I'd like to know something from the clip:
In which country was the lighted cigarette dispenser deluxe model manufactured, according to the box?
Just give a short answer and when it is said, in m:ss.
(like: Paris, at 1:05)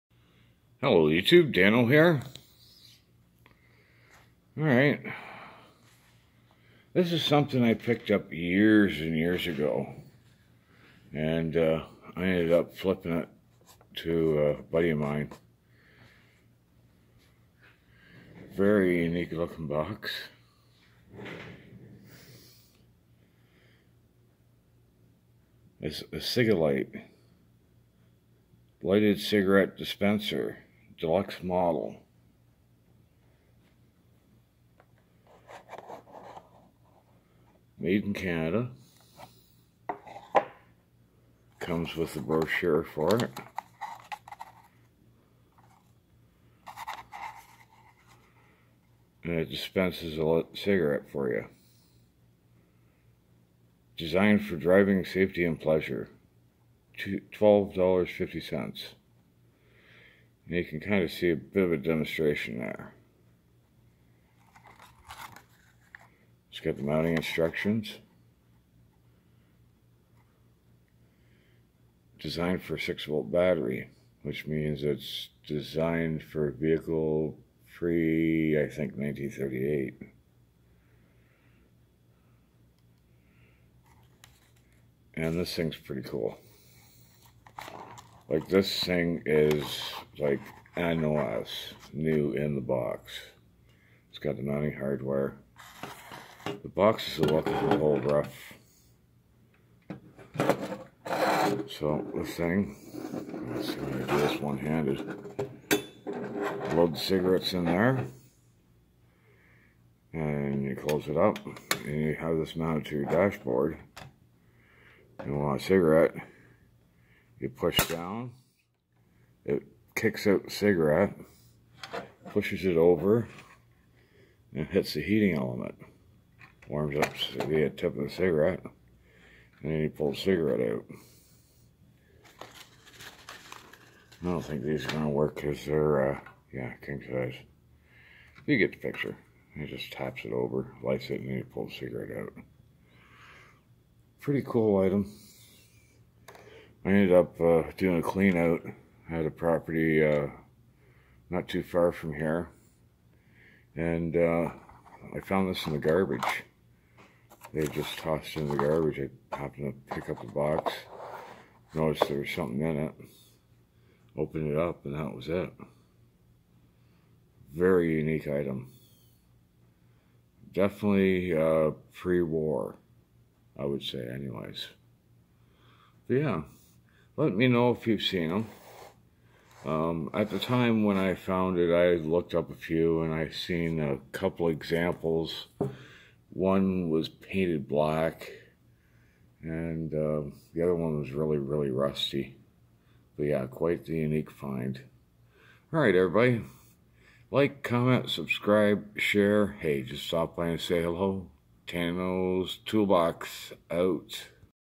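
Canada, at 0:38.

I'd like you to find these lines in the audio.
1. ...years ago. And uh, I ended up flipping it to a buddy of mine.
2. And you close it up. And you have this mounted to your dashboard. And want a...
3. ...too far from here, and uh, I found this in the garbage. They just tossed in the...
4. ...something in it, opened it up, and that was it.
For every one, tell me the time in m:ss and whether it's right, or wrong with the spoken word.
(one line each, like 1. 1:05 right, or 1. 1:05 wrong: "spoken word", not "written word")
1. 0:09 right
2. 1:50 right
3. 2:31 right
4. 2:42 right.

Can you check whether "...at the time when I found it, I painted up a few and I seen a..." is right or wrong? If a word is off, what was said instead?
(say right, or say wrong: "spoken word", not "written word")
wrong: "looked", not "painted".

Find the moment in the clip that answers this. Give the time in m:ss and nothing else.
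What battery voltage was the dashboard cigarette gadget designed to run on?
1:12.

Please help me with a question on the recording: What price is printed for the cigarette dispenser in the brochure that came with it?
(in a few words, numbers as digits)
$12.50.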